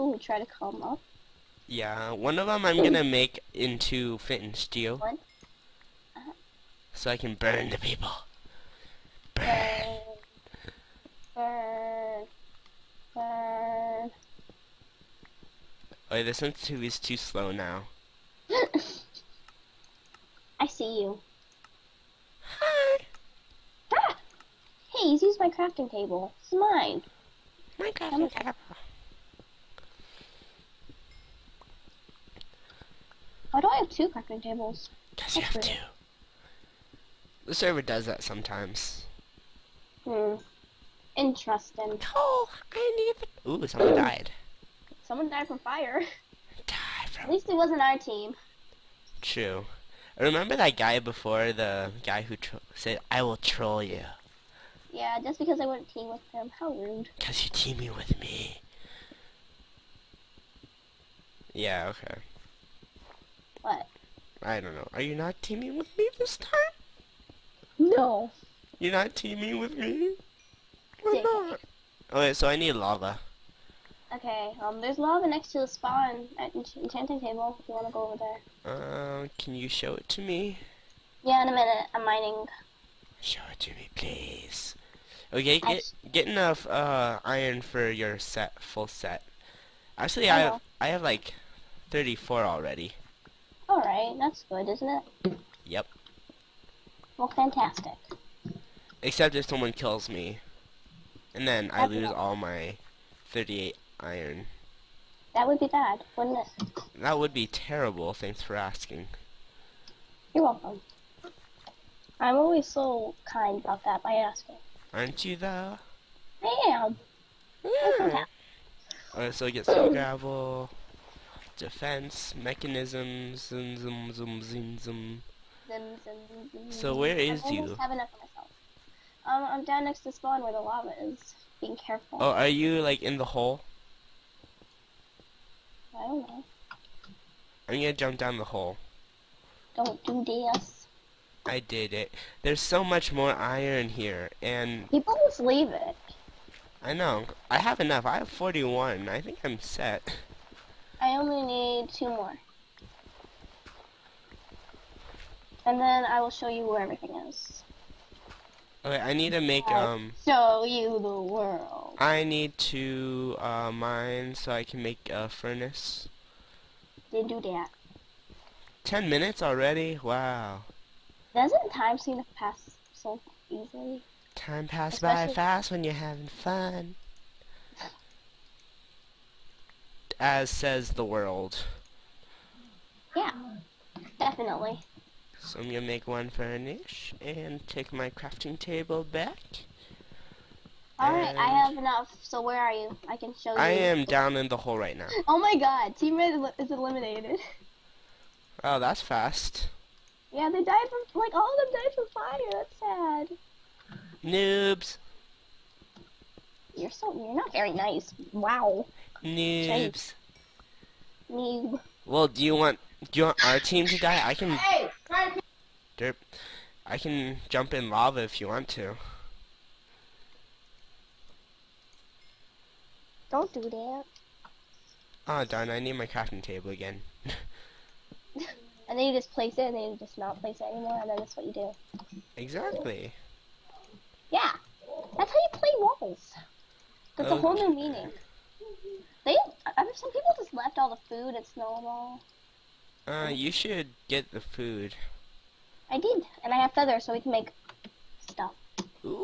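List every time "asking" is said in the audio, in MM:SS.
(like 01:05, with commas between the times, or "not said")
01:48, 01:54.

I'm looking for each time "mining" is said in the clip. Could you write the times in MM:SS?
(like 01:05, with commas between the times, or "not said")
01:22.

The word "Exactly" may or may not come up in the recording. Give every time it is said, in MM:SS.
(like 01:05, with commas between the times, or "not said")
03:52.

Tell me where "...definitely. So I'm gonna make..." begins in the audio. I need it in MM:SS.
03:04.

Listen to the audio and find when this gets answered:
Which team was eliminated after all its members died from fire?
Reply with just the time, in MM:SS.
03:15.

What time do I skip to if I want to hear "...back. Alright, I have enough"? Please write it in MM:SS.
03:09.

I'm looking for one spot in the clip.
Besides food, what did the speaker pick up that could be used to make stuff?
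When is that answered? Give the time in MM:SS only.
04:06.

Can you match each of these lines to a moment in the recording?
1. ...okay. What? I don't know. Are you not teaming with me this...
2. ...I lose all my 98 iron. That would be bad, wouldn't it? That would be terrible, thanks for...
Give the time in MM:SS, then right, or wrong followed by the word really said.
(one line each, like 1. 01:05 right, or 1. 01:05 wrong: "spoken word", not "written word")
1. 01:01 right
2. 01:41 wrong: "38", not "98".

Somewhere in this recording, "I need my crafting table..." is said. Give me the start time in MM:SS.
03:45.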